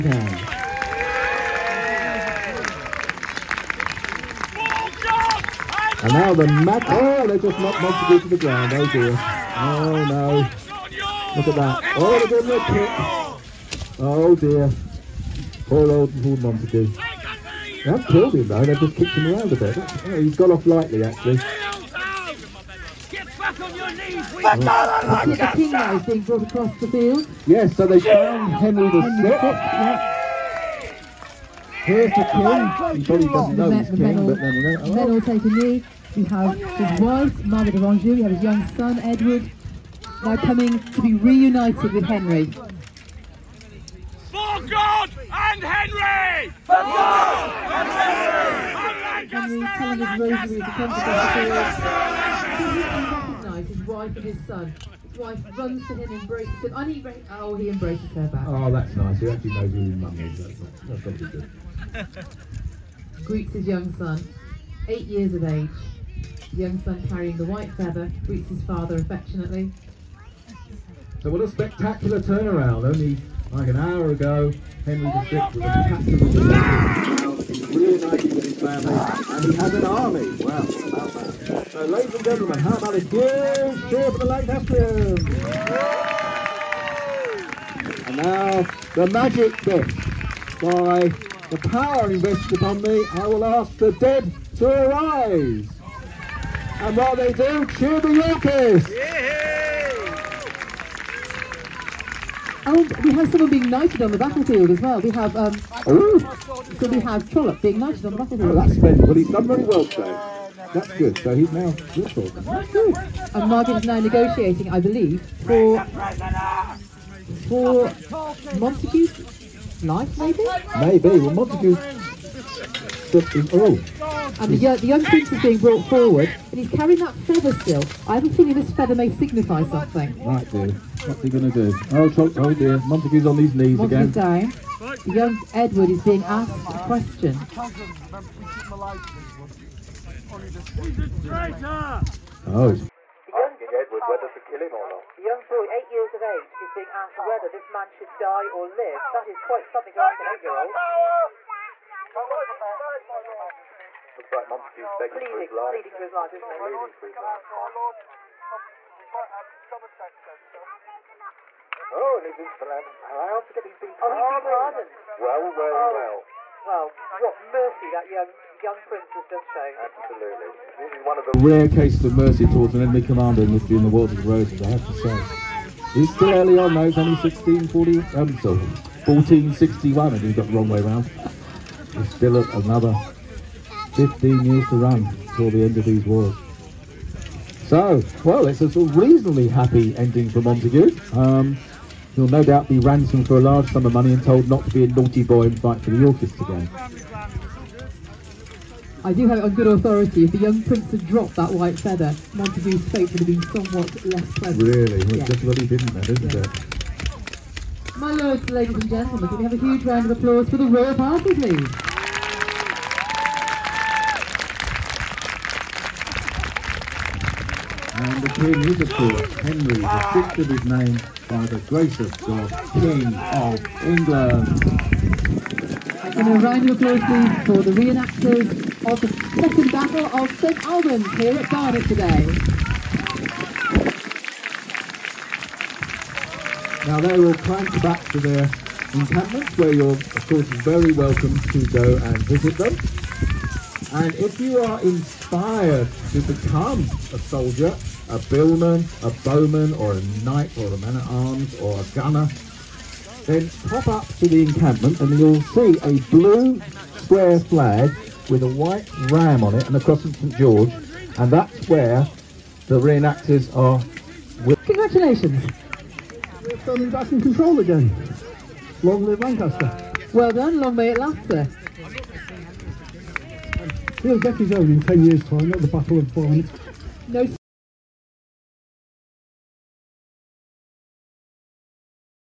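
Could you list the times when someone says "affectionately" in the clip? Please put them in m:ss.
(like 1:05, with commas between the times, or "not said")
1:08.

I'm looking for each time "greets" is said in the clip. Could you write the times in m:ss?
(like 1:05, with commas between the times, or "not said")
1:03, 1:08.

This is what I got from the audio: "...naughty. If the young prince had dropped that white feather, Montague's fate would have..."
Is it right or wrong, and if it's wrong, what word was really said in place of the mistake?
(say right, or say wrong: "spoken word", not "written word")
wrong: "authority", not "naughty".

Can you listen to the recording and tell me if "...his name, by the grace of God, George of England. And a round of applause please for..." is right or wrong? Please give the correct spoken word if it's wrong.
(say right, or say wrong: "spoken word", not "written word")
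wrong: "King", not "George".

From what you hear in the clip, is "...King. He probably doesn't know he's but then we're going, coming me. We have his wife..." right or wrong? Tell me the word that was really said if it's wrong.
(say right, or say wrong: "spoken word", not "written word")
wrong: "taking", not "coming".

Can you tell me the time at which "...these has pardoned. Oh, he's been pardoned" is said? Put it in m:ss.
2:43.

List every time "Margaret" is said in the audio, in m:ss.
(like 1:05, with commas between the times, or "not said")
0:37, 1:53.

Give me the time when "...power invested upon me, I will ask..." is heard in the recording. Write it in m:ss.
1:31.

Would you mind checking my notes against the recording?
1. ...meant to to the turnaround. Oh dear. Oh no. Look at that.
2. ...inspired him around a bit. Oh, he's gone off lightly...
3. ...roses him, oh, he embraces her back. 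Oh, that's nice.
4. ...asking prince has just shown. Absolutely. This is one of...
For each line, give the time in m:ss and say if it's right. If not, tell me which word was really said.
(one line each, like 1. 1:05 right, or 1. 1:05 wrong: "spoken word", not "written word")
1. 0:07 wrong: "ground", not "turnaround"
2. 0:18 wrong: "kicked", not "inspired"
3. 0:56 wrong: "embraces", not "roses"
4. 2:48 wrong: "young", not "asking".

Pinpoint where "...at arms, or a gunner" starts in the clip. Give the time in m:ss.
4:10.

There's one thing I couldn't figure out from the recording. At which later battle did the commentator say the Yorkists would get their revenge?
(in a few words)
Battle of Barnet.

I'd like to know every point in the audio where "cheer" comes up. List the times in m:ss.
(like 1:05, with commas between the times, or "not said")
1:23, 1:37.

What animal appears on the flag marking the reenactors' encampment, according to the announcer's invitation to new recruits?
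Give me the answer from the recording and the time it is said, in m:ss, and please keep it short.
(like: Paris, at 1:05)
Ram, at 4:19.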